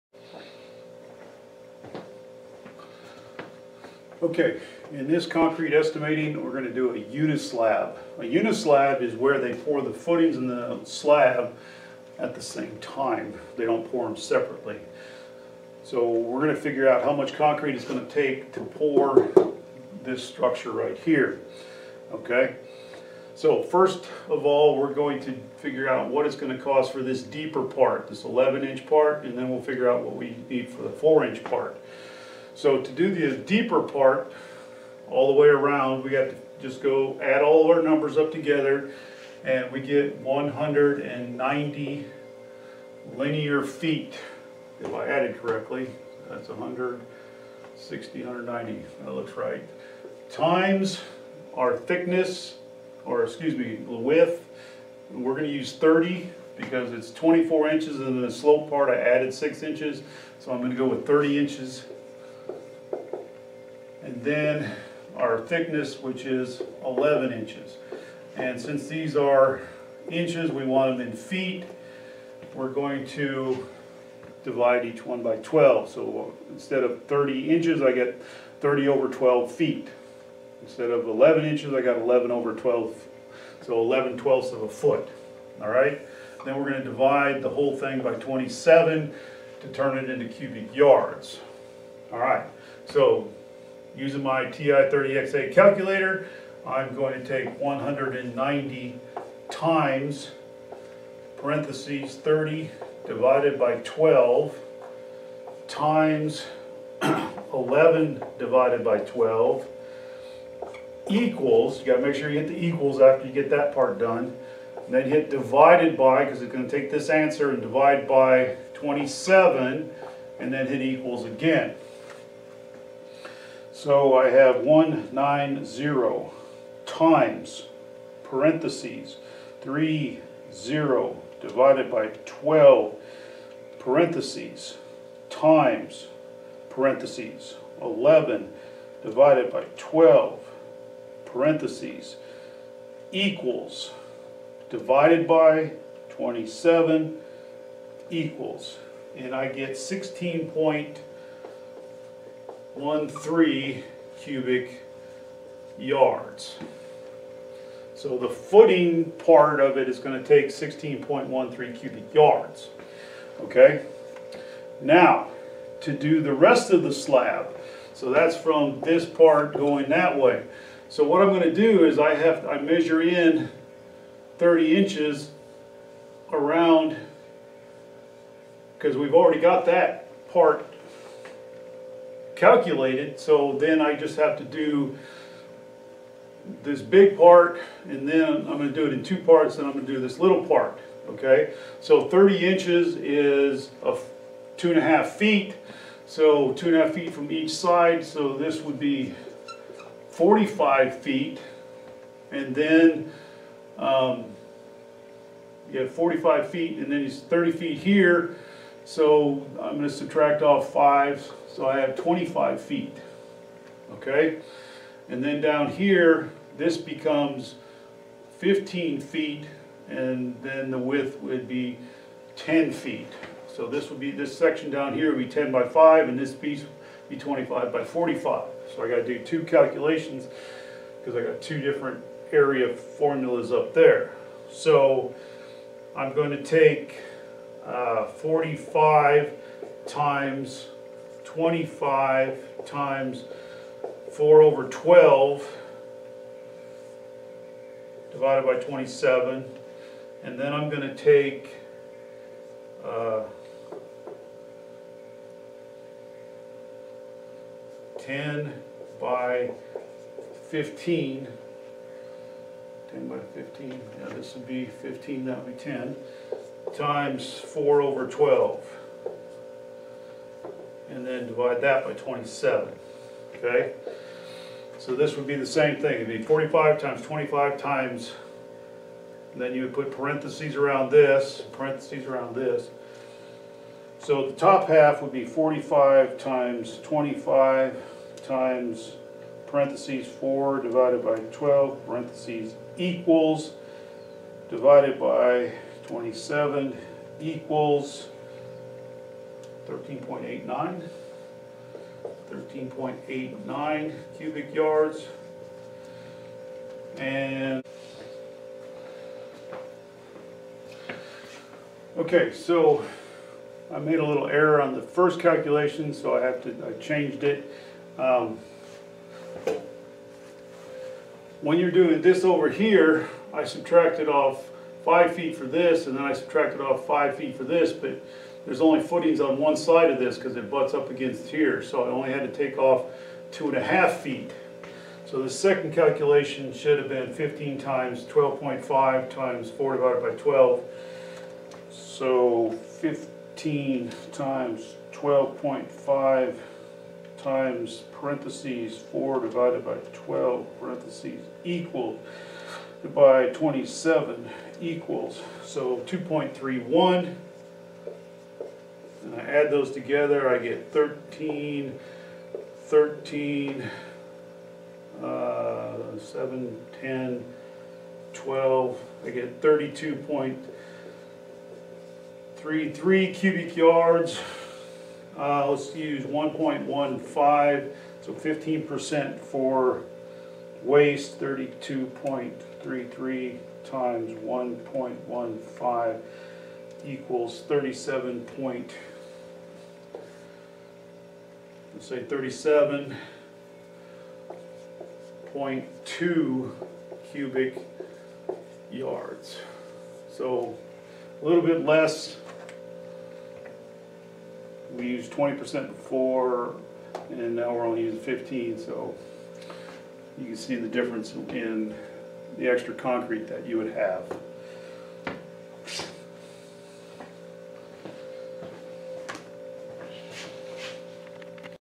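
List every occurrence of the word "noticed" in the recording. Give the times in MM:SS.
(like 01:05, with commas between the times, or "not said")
not said.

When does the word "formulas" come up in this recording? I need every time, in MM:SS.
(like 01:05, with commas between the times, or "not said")
03:52.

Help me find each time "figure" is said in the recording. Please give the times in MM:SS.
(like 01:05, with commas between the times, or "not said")
00:16, 00:25, 00:29.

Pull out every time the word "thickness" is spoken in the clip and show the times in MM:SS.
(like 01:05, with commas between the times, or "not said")
00:51, 01:05.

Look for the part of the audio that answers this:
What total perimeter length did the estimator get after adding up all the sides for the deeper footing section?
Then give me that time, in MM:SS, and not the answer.
00:40.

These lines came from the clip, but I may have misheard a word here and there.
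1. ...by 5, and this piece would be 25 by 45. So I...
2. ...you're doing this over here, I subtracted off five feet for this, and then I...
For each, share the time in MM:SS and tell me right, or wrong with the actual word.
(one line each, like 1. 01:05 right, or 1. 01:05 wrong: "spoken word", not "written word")
1. 03:45 right
2. 05:21 right.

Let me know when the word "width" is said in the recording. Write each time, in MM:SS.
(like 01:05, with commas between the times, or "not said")
00:53, 03:40.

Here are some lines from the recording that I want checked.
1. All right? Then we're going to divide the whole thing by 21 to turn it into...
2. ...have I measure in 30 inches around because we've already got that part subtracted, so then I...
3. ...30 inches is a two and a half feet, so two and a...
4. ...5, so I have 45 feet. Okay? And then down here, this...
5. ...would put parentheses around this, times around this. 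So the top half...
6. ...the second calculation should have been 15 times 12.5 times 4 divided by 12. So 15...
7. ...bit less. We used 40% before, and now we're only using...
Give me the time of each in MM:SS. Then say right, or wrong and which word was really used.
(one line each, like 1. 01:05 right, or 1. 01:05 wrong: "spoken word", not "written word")
1. 01:25 wrong: "27", not "21"
2. 02:52 wrong: "calculated", not "subtracted"
3. 03:12 right
4. 03:30 wrong: "25", not "45"
5. 04:39 wrong: "parentheses", not "times"
6. 05:35 right
7. 06:41 wrong: "20", not "40".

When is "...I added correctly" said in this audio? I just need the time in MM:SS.
00:44.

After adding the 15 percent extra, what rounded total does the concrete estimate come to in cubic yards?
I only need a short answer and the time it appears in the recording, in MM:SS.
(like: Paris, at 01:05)
37.2 cubic yards, at 06:32.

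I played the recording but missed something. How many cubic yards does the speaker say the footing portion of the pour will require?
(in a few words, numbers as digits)
16.13 cubic yards.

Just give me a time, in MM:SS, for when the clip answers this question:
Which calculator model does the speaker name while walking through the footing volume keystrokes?
01:34.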